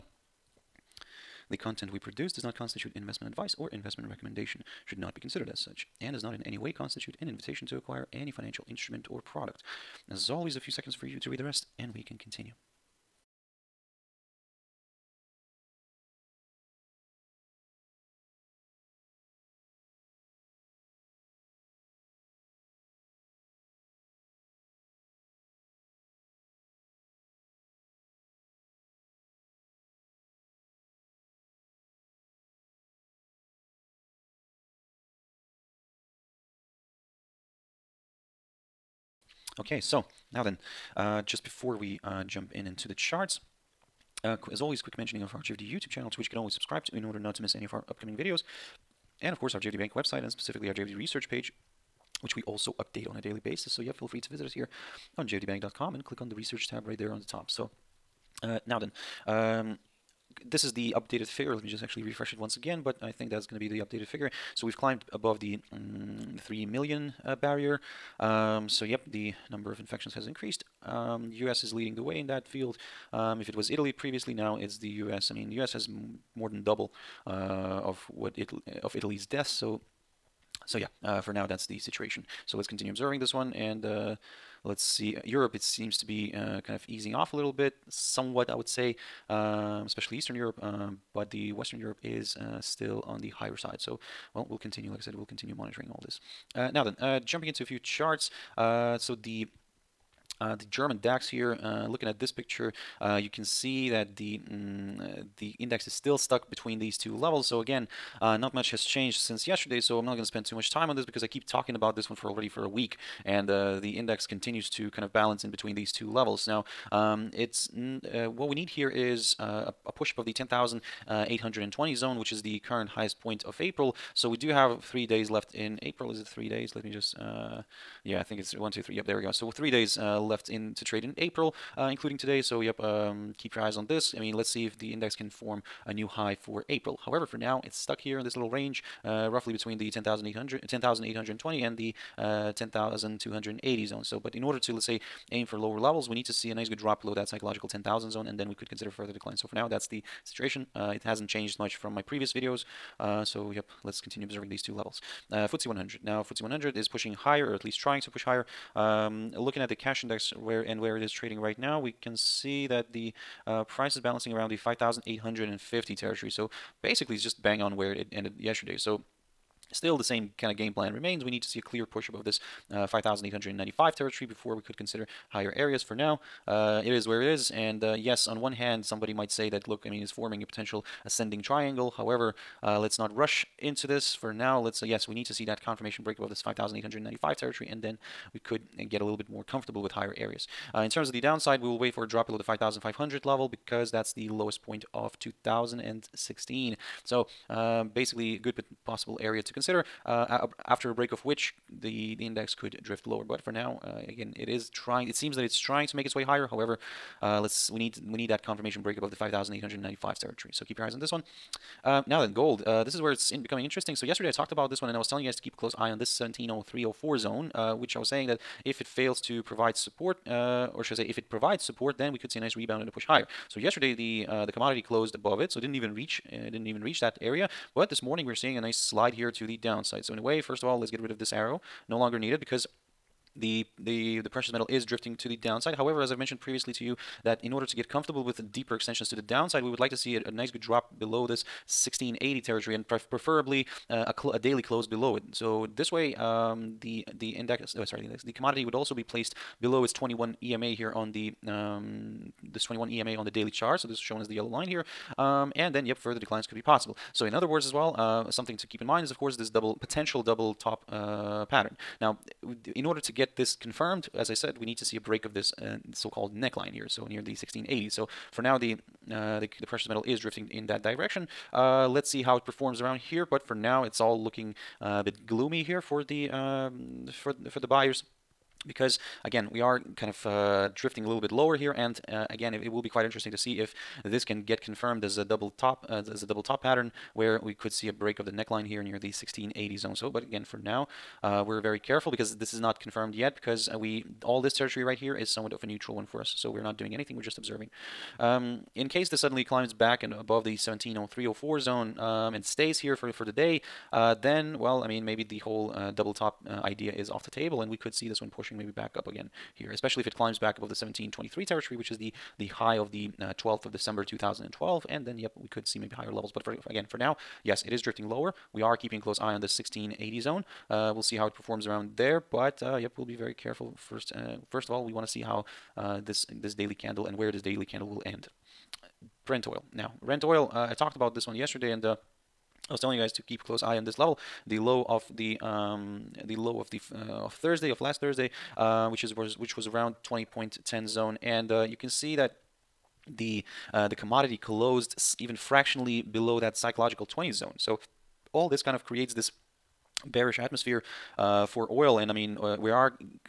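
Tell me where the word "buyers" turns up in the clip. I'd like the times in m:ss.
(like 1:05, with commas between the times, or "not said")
4:37.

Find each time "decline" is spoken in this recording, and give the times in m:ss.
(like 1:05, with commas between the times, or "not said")
2:29, 4:16.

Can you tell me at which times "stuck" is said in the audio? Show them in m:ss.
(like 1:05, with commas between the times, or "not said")
1:46, 2:17.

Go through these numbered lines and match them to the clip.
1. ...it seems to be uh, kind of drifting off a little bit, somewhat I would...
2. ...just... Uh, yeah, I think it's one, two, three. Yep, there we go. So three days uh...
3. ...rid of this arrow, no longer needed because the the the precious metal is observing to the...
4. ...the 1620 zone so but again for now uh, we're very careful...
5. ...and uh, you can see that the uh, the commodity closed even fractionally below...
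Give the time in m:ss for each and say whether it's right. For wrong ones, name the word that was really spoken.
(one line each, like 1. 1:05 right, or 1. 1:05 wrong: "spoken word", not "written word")
1. 1:25 wrong: "easing", not "drifting"
2. 2:06 right
3. 3:50 wrong: "drifting", not "observing"
4. 4:48 wrong: "1680", not "1620"
5. 5:41 right.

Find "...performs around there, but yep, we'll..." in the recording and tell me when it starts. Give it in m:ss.
5:21.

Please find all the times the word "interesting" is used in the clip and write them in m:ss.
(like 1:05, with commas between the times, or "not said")
3:33, 4:43.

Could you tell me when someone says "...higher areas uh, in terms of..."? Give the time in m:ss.
3:09.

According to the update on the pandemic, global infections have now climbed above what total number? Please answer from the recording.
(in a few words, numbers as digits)
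3 million.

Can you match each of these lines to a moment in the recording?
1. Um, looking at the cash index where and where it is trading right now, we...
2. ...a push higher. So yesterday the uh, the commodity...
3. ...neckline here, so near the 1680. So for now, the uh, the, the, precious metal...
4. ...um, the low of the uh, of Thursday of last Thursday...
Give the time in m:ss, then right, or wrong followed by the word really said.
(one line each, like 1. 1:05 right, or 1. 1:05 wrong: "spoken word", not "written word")
1. 2:38 right
2. 3:42 right
3. 4:26 right
4. 5:35 right.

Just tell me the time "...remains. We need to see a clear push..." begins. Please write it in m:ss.
2:50.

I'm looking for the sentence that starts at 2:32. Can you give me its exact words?
Uh, so yep, let's continue observing these two levels.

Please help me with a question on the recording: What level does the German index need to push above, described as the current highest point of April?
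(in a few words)
10,820.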